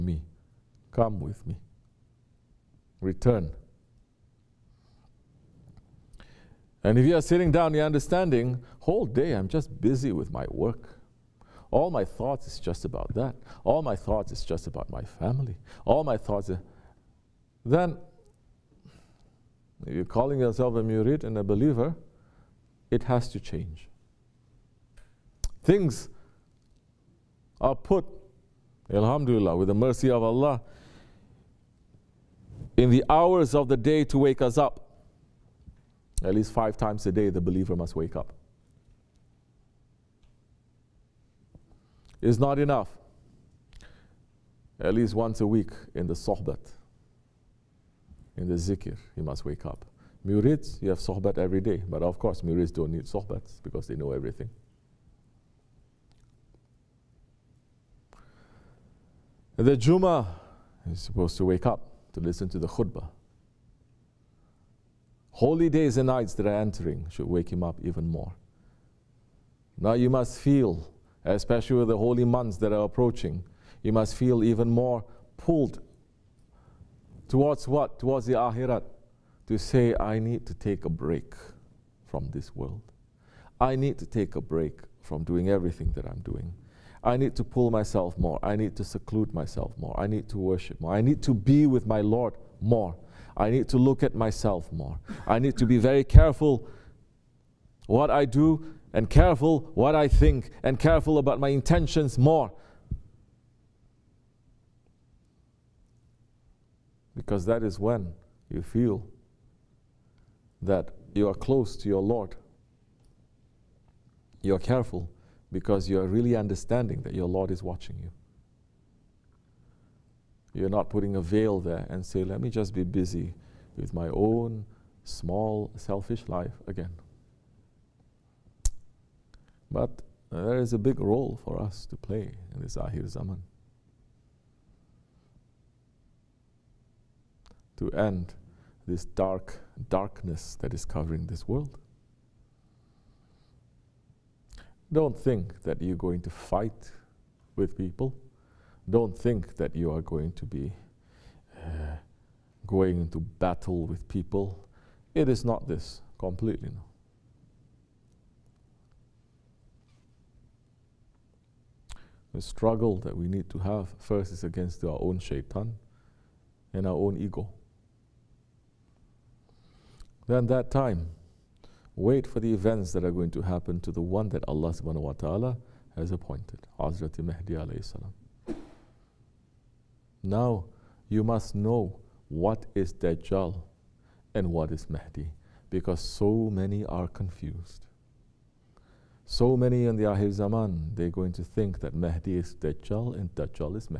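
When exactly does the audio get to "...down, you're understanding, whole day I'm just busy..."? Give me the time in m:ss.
0:07.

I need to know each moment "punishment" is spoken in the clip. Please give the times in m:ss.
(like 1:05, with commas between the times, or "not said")
not said.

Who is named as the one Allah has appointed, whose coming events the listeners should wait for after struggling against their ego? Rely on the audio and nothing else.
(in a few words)
Hazrat Mahdi.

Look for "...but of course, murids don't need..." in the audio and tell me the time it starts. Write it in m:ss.
0:51.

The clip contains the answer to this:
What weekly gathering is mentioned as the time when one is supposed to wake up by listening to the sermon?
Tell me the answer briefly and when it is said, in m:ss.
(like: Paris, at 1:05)
Juma, at 0:59.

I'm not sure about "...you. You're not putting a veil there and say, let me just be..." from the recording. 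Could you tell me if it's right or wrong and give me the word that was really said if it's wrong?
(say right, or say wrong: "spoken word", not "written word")
right.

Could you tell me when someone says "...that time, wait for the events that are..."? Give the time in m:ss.
2:50.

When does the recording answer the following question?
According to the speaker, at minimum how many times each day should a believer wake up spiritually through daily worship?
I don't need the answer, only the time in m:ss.
0:36.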